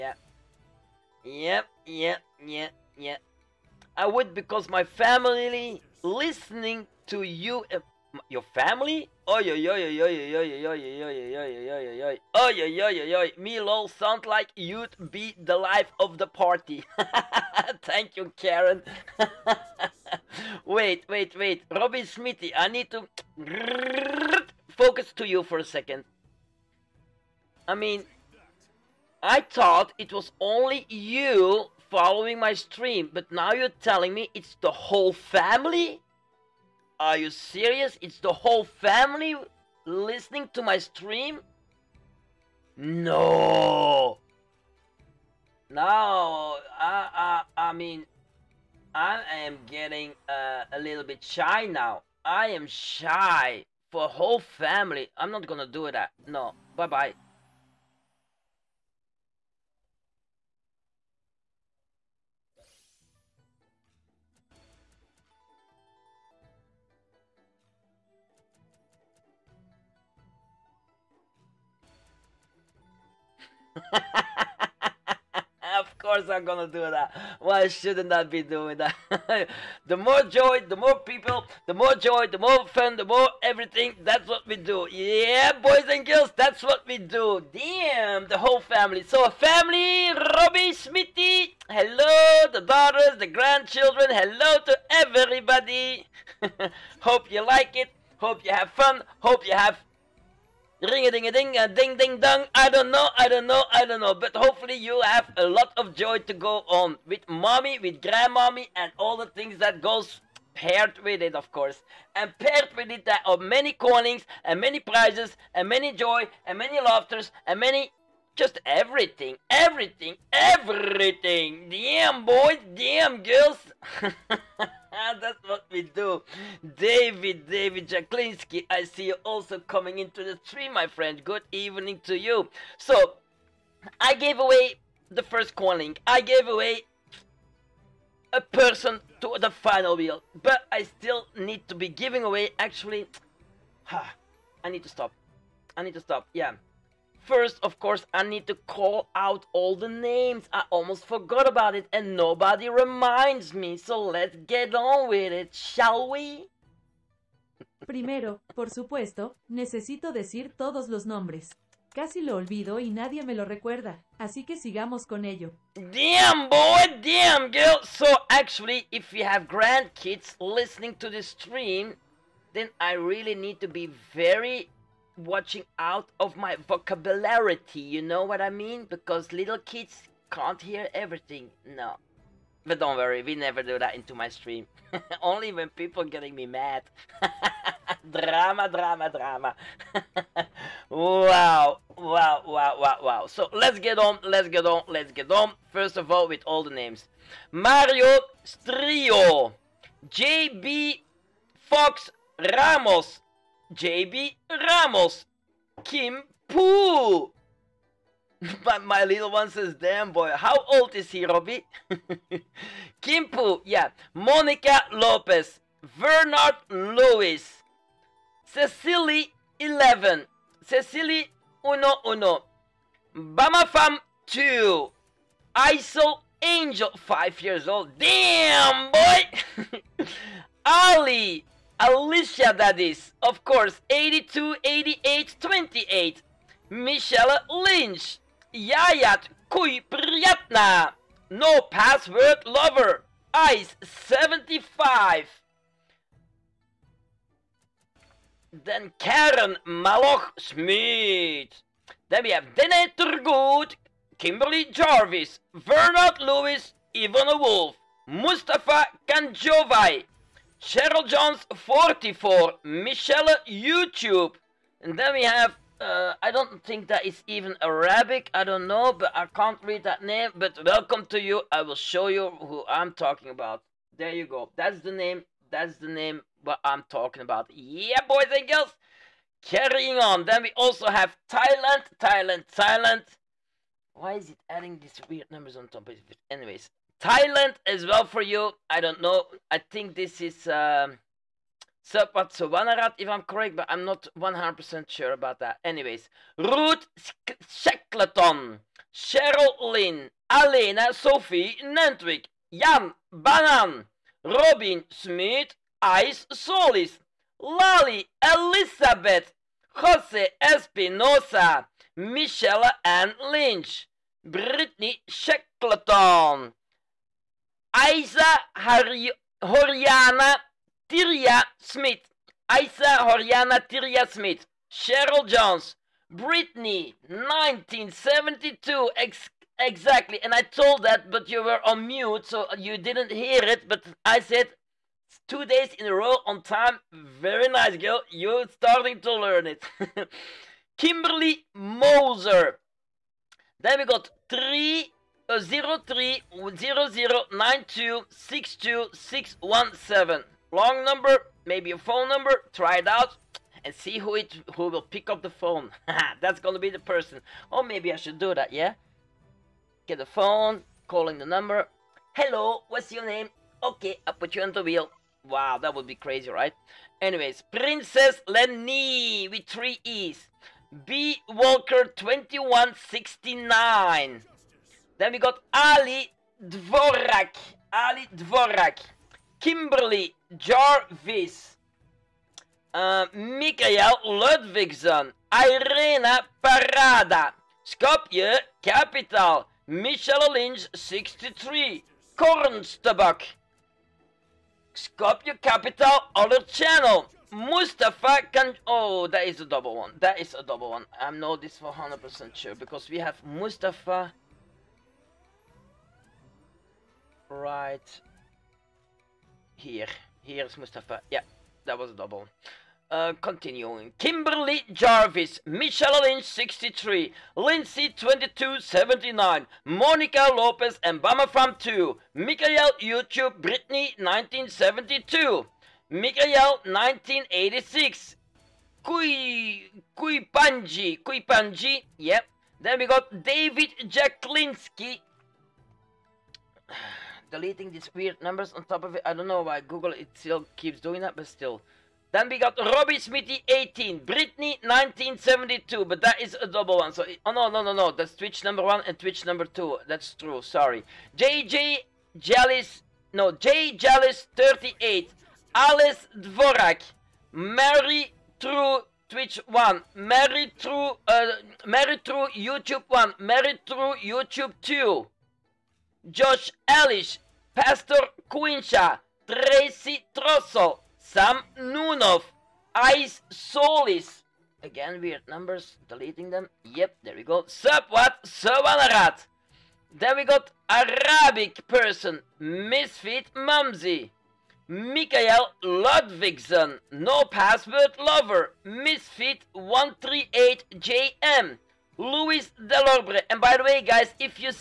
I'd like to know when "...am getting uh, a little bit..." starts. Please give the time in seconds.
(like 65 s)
49 s.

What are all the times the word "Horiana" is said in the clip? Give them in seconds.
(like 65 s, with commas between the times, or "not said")
318 s, 323 s.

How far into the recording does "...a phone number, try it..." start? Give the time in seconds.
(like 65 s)
351 s.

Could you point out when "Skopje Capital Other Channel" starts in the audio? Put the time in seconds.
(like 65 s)
394 s.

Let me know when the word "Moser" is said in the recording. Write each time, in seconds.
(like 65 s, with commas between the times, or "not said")
341 s.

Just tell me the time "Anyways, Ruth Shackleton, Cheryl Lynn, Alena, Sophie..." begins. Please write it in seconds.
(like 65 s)
295 s.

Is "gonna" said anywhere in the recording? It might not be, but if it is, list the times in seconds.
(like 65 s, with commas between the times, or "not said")
55 s, 76 s, 356 s.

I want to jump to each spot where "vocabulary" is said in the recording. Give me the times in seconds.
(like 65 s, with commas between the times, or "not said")
176 s.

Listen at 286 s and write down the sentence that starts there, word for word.
Anyways, Thailand as well for you.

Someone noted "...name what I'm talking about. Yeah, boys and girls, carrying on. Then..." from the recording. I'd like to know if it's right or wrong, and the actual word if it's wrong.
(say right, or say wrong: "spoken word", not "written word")
right.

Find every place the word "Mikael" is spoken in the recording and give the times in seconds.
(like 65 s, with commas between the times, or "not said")
383 s, 484 s.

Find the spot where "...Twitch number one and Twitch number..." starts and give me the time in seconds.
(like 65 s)
448 s.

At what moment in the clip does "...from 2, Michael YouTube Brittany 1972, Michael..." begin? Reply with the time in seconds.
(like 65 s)
421 s.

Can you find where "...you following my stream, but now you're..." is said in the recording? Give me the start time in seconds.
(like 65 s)
30 s.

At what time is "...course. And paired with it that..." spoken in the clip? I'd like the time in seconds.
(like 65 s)
111 s.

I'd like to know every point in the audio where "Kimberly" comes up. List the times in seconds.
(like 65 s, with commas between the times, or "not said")
254 s, 340 s, 379 s, 413 s.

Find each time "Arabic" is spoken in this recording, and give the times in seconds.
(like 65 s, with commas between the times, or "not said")
267 s, 480 s.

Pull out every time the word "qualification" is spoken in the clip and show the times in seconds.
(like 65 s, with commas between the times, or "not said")
not said.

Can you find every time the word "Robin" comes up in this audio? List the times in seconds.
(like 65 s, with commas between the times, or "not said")
21 s, 304 s.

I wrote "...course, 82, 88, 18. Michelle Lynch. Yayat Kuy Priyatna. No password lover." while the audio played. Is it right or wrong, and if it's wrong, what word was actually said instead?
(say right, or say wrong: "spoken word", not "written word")
wrong: "28", not "18".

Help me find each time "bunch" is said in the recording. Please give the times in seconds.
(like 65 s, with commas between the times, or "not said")
not said.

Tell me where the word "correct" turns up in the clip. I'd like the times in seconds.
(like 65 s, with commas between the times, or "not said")
293 s.